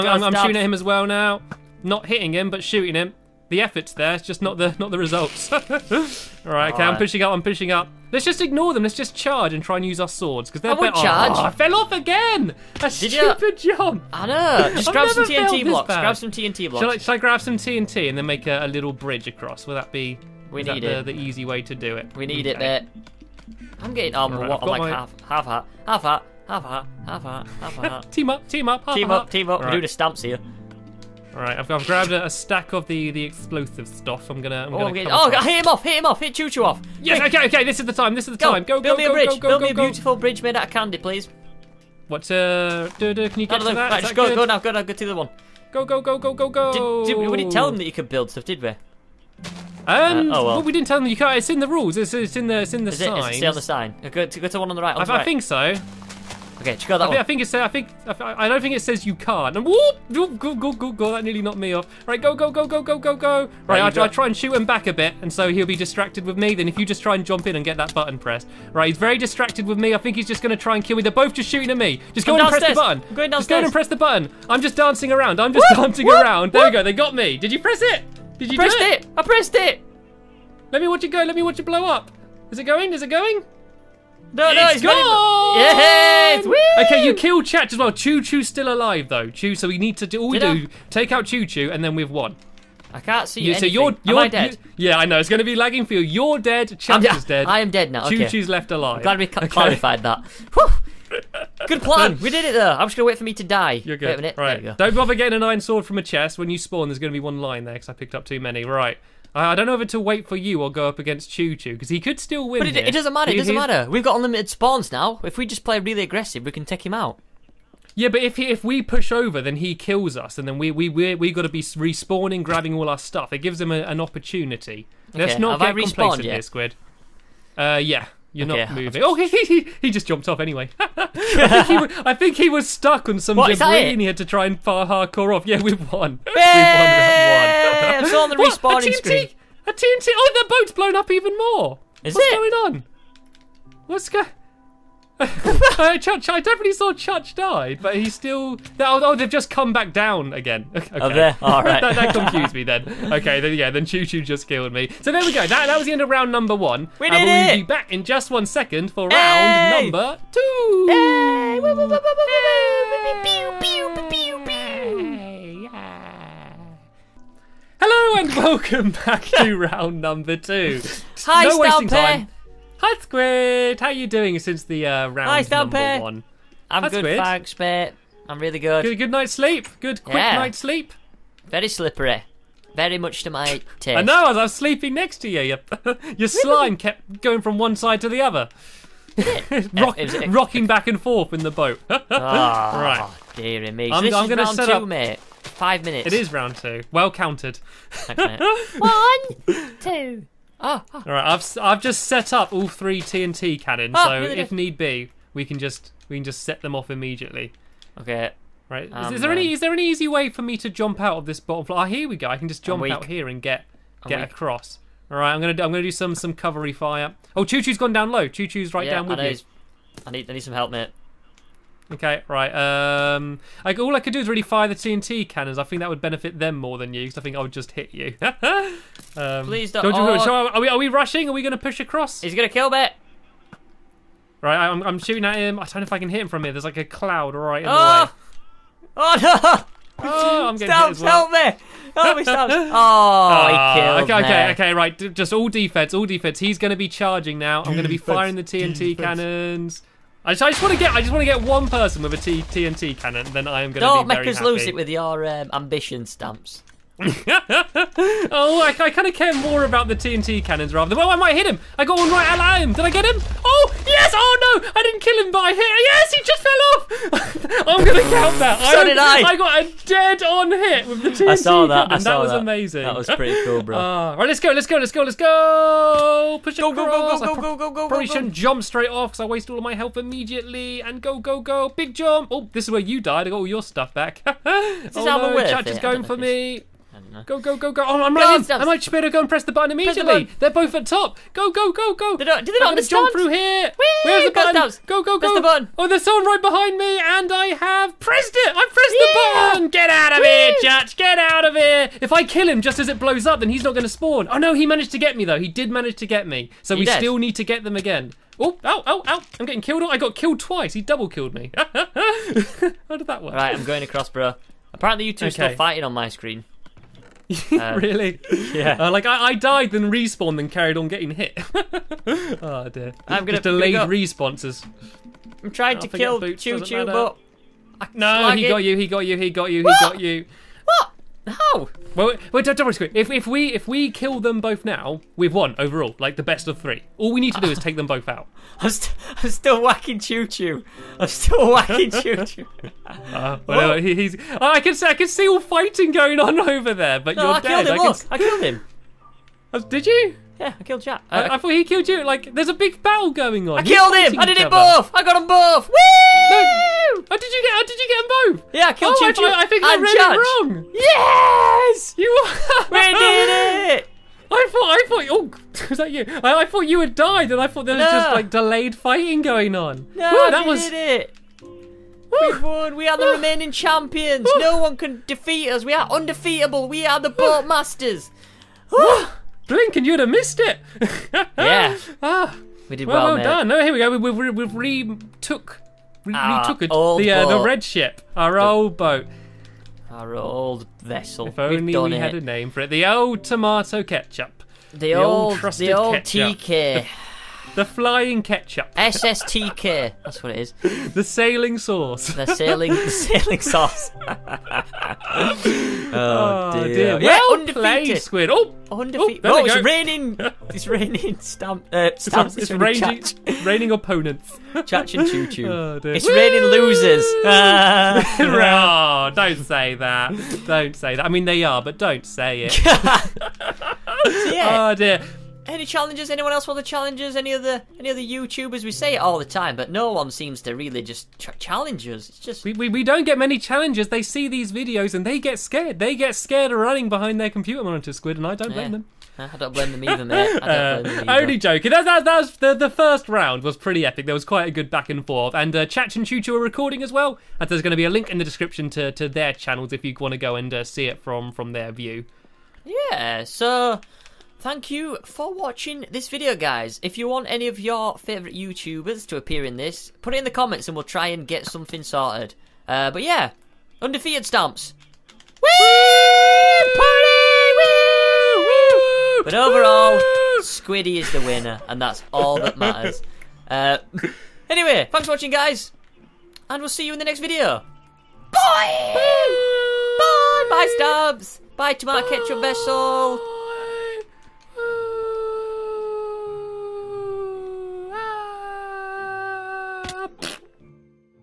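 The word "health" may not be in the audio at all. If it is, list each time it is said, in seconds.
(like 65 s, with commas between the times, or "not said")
279 s.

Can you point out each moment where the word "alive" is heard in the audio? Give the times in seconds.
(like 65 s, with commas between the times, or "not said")
88 s, 98 s.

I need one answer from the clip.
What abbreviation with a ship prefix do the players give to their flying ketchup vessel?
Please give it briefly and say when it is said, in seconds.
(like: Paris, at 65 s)
SSTK, at 398 s.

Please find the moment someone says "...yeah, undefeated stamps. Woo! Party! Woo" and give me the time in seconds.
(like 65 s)
463 s.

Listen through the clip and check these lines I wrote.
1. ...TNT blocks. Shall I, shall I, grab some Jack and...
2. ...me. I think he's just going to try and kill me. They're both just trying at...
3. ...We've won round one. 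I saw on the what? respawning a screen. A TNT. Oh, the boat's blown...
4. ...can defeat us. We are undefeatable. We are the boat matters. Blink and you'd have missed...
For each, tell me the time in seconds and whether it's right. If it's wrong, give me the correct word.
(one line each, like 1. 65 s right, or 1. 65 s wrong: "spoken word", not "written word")
1. 16 s wrong: "TNT", not "Jack"
2. 69 s wrong: "shooting", not "trying"
3. 136 s right
4. 374 s wrong: "masters", not "matters".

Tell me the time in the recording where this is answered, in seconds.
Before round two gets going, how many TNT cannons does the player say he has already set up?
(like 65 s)
202 s.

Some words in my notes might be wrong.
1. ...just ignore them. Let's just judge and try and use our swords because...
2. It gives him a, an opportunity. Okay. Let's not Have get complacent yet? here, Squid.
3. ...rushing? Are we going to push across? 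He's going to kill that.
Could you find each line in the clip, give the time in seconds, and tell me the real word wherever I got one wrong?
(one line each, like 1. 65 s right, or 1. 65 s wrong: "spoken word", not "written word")
1. 8 s wrong: "charge", not "judge"
2. 123 s right
3. 230 s right.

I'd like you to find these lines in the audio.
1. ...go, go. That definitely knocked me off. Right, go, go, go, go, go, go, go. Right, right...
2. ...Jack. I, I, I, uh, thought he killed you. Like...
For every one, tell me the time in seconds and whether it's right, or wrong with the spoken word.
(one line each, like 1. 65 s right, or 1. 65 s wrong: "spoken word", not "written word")
1. 60 s wrong: "nearly", not "definitely"
2. 350 s right.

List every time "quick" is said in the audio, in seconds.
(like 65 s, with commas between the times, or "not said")
37 s, 180 s.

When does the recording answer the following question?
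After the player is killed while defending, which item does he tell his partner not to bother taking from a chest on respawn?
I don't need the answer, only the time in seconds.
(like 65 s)
105 s.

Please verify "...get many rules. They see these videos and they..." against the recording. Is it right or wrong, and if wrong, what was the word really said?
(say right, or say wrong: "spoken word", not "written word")
wrong: "challenges", not "rules".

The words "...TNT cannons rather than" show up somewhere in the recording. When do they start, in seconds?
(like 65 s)
259 s.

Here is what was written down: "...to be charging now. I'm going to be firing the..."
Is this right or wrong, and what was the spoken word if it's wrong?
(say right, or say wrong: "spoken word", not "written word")
right.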